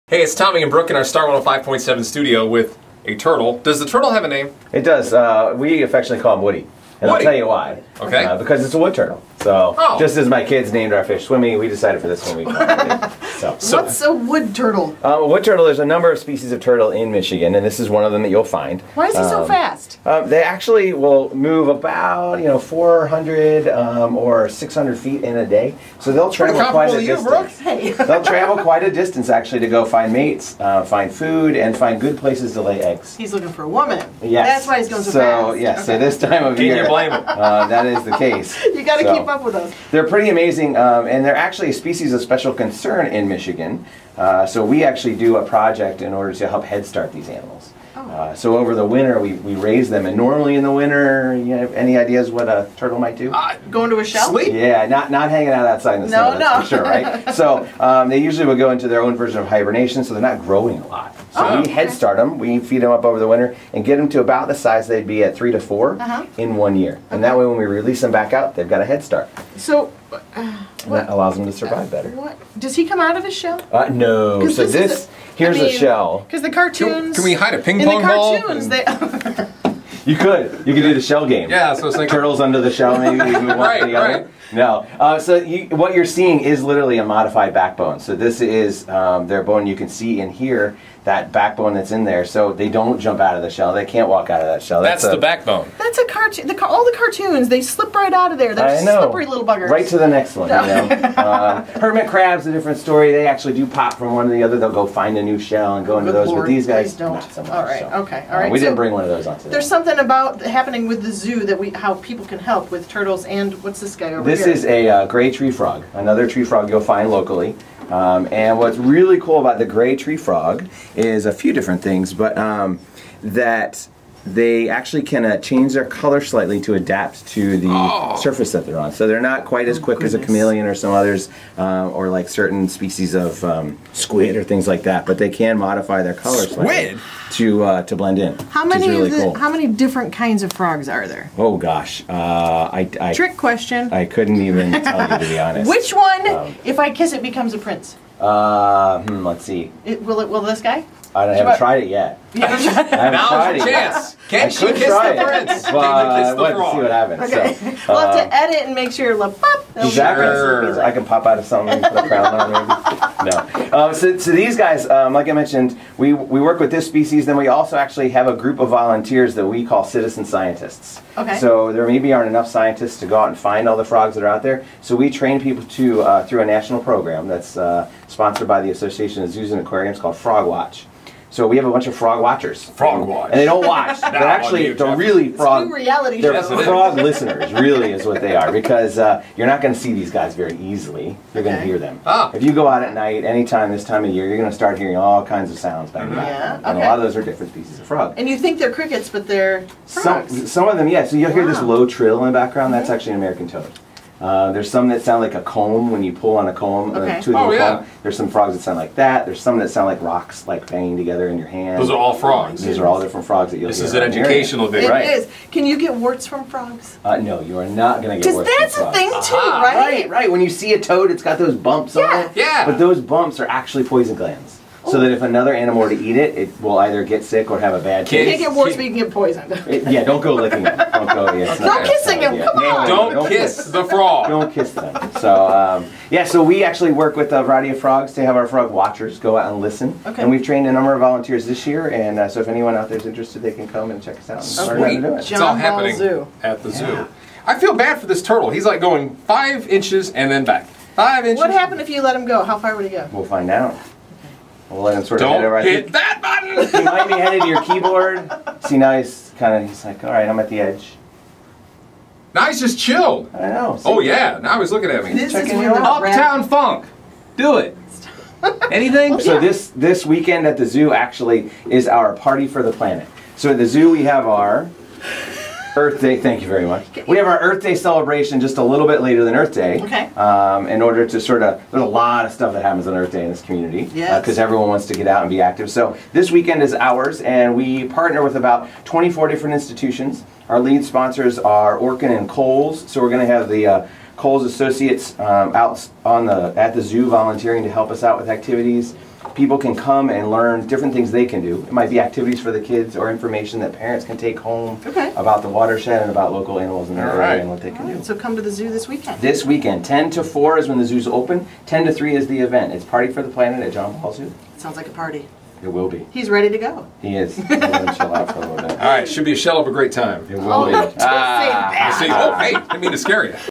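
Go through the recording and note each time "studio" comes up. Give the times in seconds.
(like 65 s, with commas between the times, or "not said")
2 s.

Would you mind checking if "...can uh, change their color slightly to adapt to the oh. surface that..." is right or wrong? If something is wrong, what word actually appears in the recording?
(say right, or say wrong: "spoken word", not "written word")
right.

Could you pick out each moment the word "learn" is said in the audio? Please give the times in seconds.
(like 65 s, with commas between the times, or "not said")
244 s, 300 s.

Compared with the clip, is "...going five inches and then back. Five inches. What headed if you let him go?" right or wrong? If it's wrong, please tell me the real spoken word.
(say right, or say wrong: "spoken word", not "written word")
wrong: "happened", not "headed".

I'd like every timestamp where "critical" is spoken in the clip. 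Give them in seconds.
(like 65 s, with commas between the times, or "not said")
not said.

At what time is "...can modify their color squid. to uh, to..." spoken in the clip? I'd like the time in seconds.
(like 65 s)
135 s.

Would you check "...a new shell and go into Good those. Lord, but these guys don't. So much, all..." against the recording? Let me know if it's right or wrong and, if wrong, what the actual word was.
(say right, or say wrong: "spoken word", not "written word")
right.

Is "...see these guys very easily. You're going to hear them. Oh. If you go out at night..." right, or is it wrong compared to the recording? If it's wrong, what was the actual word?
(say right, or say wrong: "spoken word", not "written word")
right.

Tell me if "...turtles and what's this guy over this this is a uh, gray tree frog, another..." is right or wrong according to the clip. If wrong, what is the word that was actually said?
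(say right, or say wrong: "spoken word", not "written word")
right.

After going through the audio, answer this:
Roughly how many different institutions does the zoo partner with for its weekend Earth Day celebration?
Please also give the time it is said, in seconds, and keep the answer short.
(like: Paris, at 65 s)
24, at 288 s.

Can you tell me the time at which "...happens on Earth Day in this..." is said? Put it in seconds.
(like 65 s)
282 s.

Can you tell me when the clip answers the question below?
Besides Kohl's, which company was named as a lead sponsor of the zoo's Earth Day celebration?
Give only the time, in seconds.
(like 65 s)
291 s.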